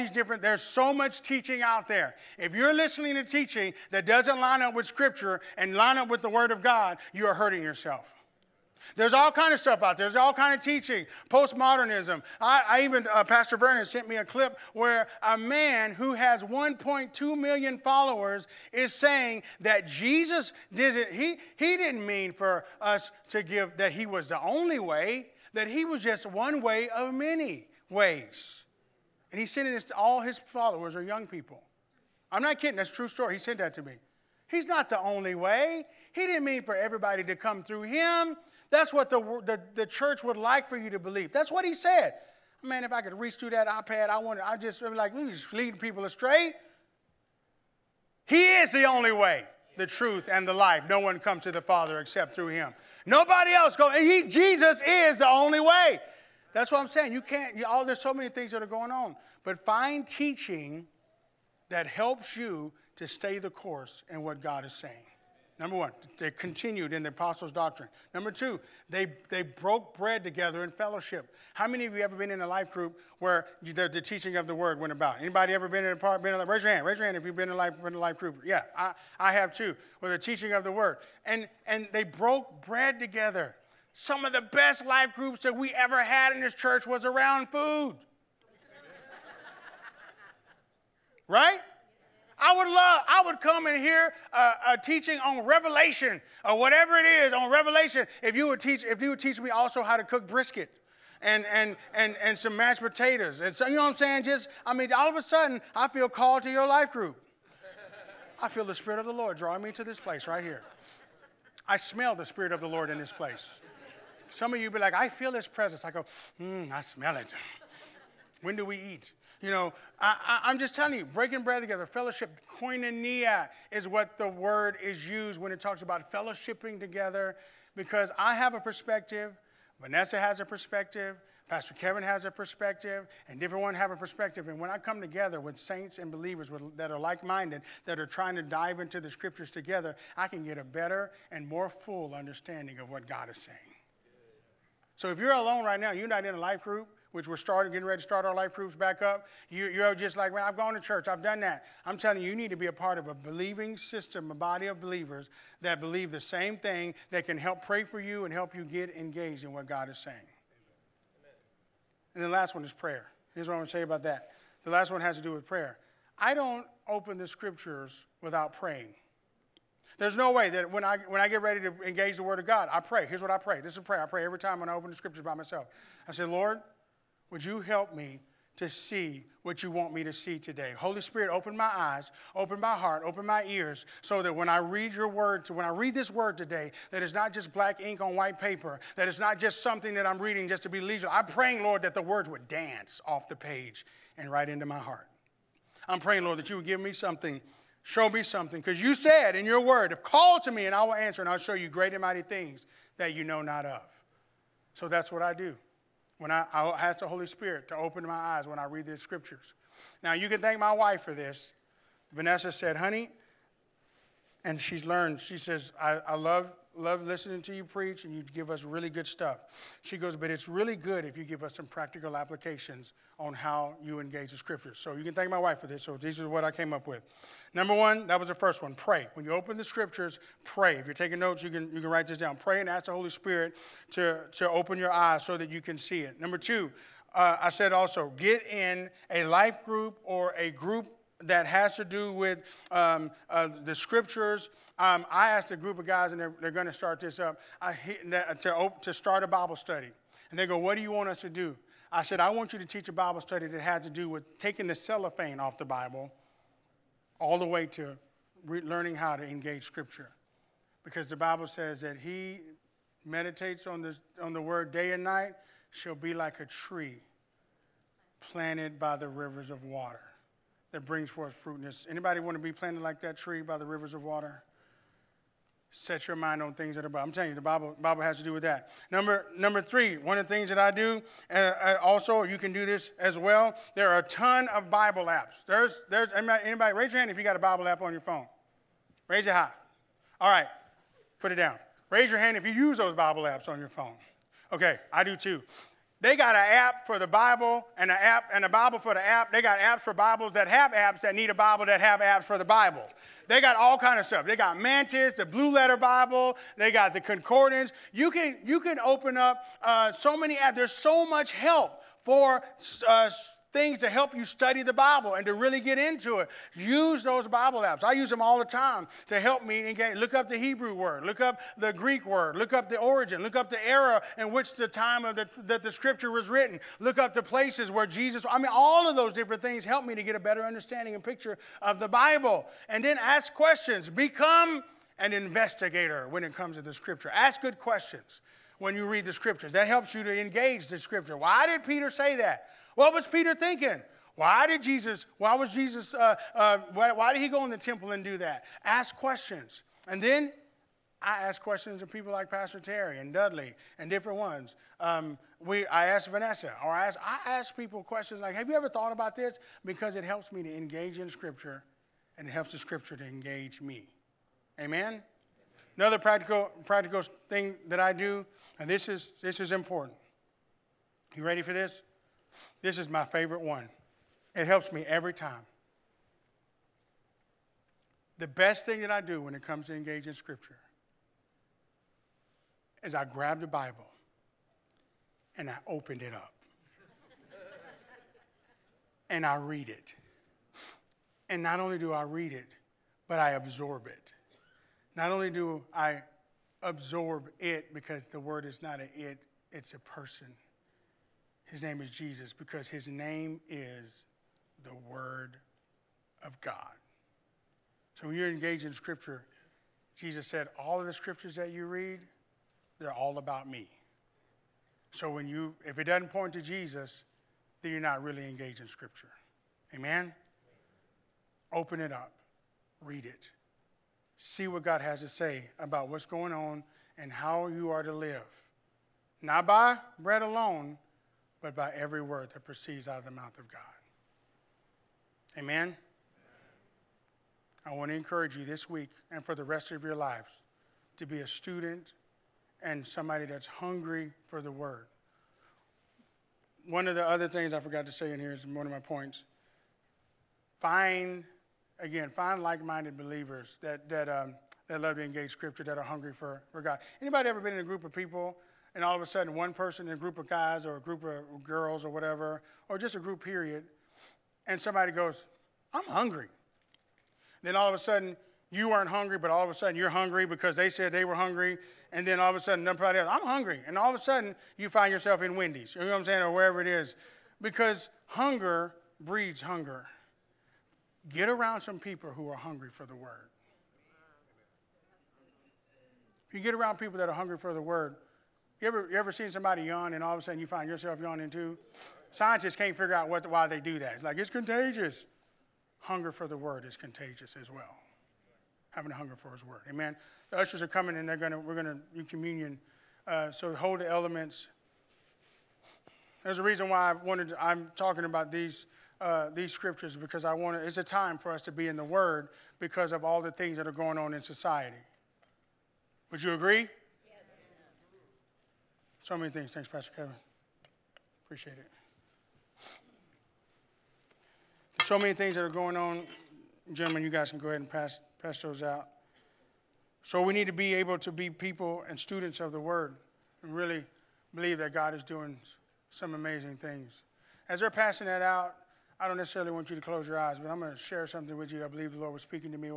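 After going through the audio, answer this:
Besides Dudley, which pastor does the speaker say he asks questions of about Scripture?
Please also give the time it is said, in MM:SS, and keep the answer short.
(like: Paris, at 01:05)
Pastor Terry, at 05:52.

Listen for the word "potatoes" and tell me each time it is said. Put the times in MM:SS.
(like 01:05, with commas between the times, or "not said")
01:42.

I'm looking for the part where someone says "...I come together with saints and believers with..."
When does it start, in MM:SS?
02:14.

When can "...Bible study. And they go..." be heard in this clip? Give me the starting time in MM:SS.
04:09.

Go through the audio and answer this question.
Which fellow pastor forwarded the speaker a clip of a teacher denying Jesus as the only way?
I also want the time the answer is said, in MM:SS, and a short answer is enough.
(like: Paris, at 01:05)
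Pastor Vernon, at 00:13.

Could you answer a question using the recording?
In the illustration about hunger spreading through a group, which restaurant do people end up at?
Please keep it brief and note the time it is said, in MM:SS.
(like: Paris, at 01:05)
Wendy's, at 07:55.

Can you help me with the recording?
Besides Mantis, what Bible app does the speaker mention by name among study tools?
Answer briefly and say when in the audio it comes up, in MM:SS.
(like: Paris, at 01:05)
Blue Letter Bible, at 05:05.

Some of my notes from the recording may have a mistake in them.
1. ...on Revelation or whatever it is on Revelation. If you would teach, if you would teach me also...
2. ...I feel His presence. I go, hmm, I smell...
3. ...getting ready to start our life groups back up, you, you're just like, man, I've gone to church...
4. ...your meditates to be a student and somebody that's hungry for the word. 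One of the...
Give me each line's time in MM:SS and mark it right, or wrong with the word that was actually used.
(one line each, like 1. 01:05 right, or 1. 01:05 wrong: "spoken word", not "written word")
1. 01:35 right
2. 01:54 right
3. 02:27 right
4. 07:19 wrong: "lives", not "meditates".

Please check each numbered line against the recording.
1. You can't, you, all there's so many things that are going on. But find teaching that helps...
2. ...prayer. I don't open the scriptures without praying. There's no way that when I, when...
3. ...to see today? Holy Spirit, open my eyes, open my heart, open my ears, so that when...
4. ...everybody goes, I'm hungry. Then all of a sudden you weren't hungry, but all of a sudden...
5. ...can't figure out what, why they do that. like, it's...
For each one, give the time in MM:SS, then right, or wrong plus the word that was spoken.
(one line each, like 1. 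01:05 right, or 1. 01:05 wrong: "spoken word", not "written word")
1. 00:57 right
2. 02:45 right
3. 03:00 right
4. 07:44 wrong: "somebody", not "everybody"
5. 08:12 right.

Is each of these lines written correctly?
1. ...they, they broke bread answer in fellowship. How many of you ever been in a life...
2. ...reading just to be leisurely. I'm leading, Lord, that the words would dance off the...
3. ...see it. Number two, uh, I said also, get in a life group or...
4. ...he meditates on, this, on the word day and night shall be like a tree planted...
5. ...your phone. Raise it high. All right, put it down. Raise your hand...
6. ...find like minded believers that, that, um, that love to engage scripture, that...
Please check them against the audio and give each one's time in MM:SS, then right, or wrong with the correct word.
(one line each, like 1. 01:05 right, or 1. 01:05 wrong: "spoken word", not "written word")
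1. 01:08 wrong: "together", not "answer"
2. 03:10 wrong: "praying", not "leading"
3. 03:55 right
4. 04:21 right
5. 04:47 right
6. 07:32 right.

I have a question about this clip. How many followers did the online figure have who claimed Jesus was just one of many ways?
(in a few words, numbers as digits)
1.2 million.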